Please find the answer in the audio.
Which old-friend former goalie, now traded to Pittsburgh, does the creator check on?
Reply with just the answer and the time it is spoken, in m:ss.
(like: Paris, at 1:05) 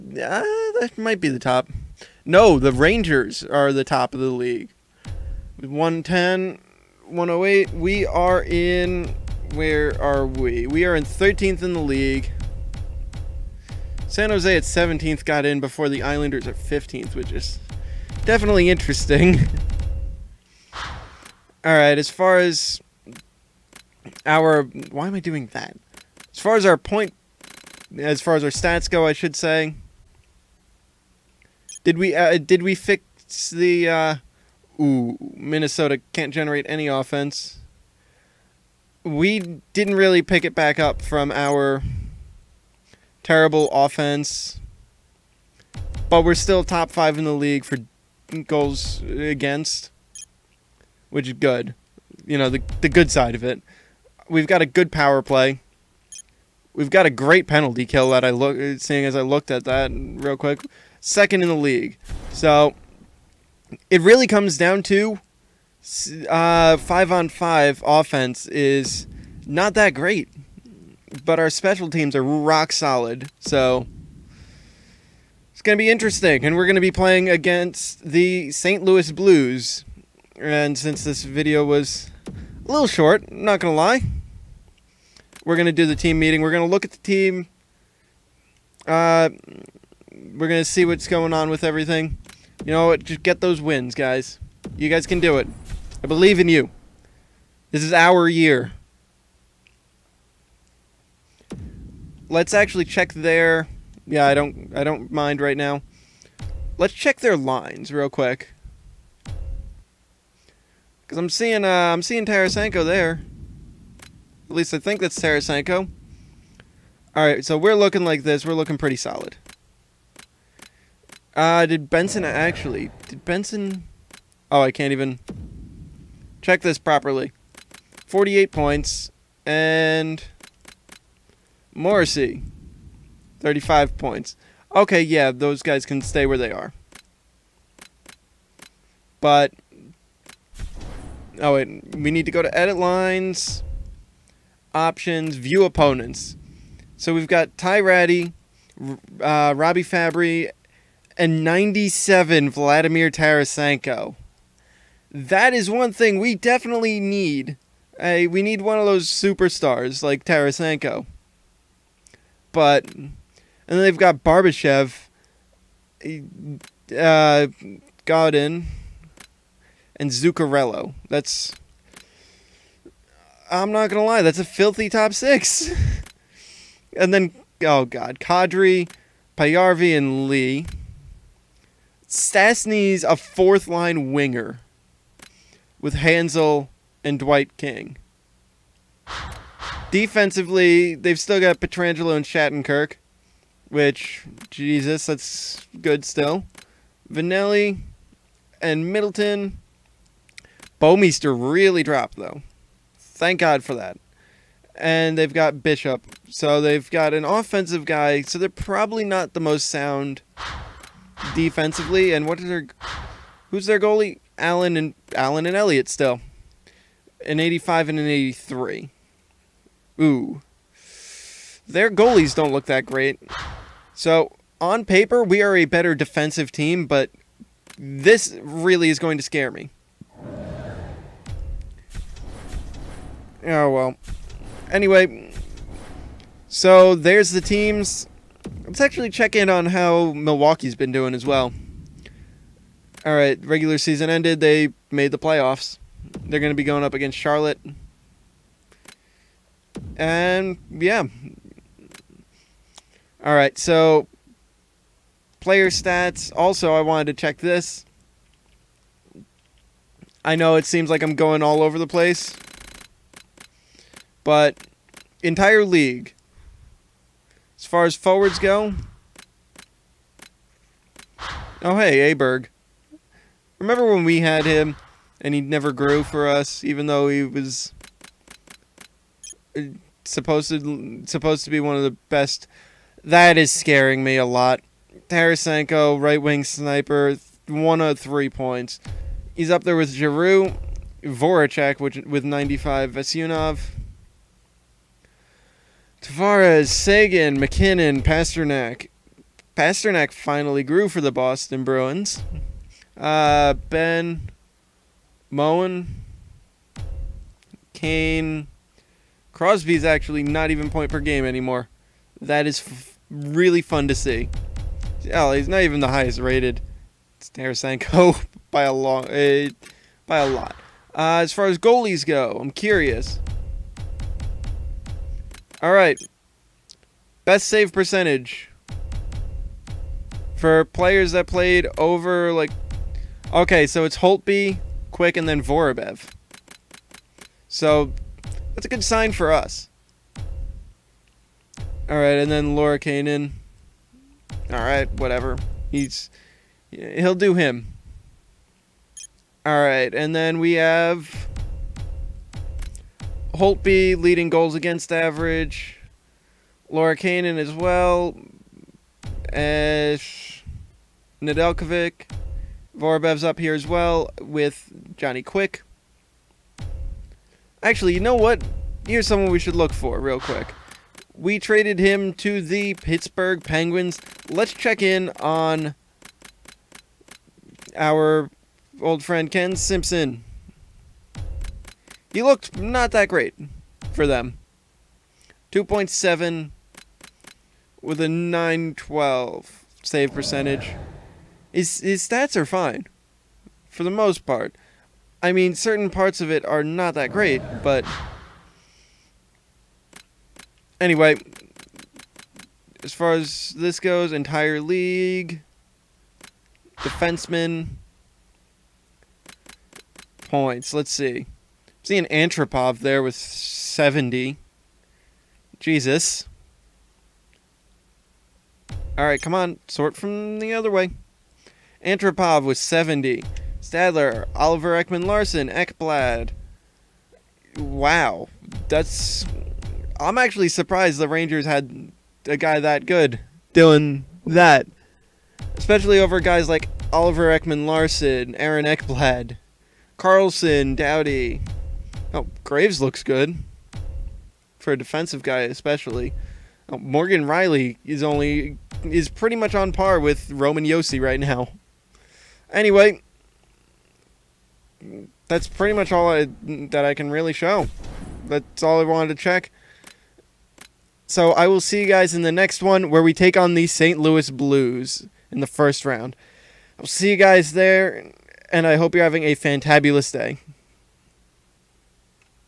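Ken Simpson, at 6:19.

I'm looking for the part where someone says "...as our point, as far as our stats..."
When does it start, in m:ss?
0:26.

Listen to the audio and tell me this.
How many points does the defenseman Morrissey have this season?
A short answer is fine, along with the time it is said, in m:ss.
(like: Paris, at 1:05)
35, at 2:13.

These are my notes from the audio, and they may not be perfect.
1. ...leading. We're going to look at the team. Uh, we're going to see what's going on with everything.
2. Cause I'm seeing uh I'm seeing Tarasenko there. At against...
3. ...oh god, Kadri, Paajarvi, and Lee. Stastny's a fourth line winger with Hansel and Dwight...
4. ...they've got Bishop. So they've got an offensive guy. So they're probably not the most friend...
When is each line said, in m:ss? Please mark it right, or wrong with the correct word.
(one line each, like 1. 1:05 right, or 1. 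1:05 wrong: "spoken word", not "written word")
1. 1:26 wrong: "meeting", not "leading"
2. 1:51 wrong: "least", not "against"
3. 2:57 right
4. 3:25 wrong: "sound", not "friend".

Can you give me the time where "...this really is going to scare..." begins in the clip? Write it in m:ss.
3:47.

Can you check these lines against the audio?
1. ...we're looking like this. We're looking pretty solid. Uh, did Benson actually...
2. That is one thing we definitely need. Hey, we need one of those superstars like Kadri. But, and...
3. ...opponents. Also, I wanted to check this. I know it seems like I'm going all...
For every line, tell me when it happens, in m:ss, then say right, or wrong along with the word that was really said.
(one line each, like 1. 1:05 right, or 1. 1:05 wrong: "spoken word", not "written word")
1. 1:57 right
2. 2:35 wrong: "Tarasenko", not "Kadri"
3. 4:15 wrong: "stats", not "opponents".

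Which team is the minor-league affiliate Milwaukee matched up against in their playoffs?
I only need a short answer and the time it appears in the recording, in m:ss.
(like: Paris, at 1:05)
Charlotte, at 4:07.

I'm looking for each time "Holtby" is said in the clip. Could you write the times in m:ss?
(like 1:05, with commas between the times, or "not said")
5:33, 5:53.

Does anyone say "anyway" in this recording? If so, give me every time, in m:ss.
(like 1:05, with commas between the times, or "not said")
3:54, 6:40, 7:32.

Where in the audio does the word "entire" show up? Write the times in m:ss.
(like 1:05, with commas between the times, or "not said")
4:25, 6:44.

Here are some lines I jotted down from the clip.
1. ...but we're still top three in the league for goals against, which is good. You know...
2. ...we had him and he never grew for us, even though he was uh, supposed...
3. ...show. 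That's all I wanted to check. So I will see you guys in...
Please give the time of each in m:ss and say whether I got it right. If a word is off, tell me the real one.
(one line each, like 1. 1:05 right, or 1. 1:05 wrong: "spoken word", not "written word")
1. 0:46 wrong: "five", not "three"
2. 4:34 right
3. 7:37 right.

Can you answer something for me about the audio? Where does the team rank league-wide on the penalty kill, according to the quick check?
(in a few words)
Second.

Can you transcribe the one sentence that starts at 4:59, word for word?
Pastrnak finally grew for the Boston Bruins.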